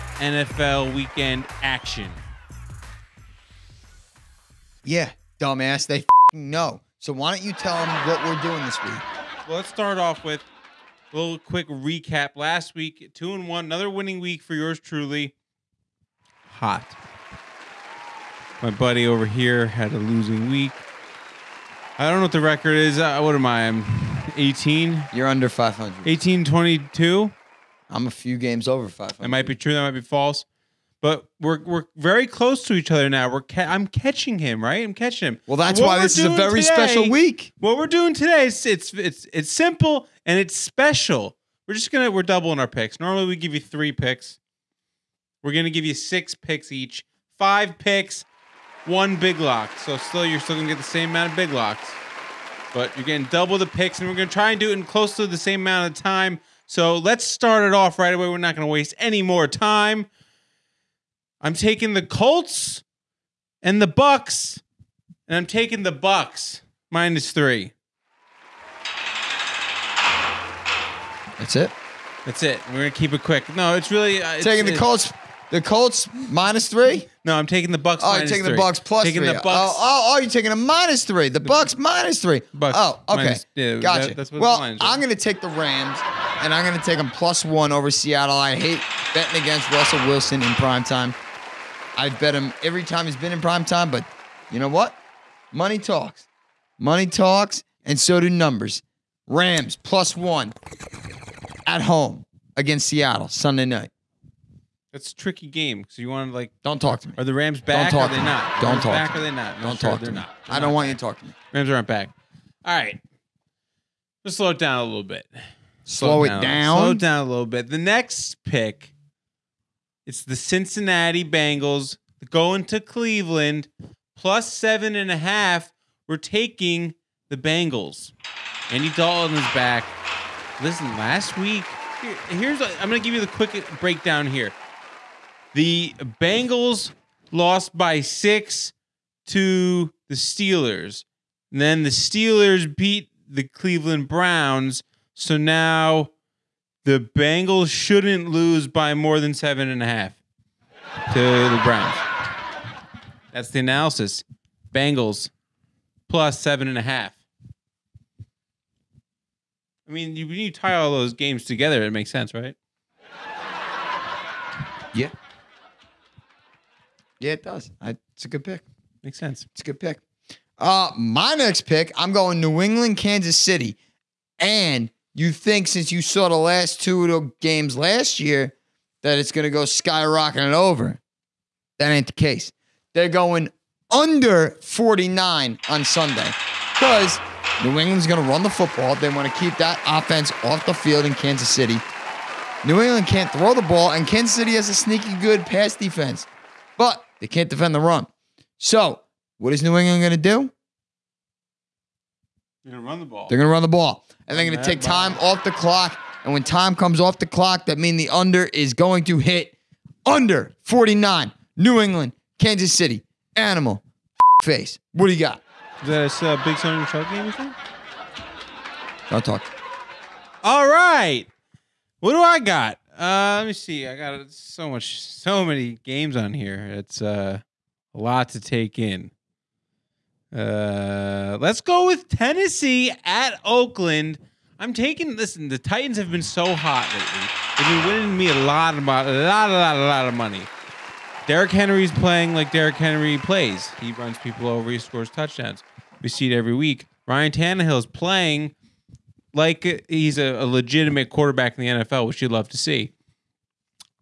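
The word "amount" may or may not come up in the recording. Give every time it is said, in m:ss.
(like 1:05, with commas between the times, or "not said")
0:51, 0:55.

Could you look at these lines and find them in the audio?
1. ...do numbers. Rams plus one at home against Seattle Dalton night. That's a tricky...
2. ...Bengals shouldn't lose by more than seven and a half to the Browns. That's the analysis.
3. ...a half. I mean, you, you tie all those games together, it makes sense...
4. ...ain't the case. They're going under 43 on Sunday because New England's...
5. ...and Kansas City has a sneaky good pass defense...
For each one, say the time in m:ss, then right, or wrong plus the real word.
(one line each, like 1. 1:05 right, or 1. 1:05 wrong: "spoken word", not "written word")
1. 1:38 wrong: "Sunday", not "Dalton"
2. 2:27 right
3. 2:36 right
4. 3:01 wrong: "49", not "43"
5. 3:13 right.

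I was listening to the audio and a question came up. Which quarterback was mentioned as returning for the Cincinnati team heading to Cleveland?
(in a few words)
Andy Dalton.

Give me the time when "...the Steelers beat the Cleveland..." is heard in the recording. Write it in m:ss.
2:21.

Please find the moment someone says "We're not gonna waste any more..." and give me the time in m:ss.
0:58.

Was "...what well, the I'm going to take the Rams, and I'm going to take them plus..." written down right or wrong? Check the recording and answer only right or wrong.
right.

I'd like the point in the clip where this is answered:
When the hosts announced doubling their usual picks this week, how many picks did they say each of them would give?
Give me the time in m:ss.
0:45.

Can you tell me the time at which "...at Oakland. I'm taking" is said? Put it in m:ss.
3:53.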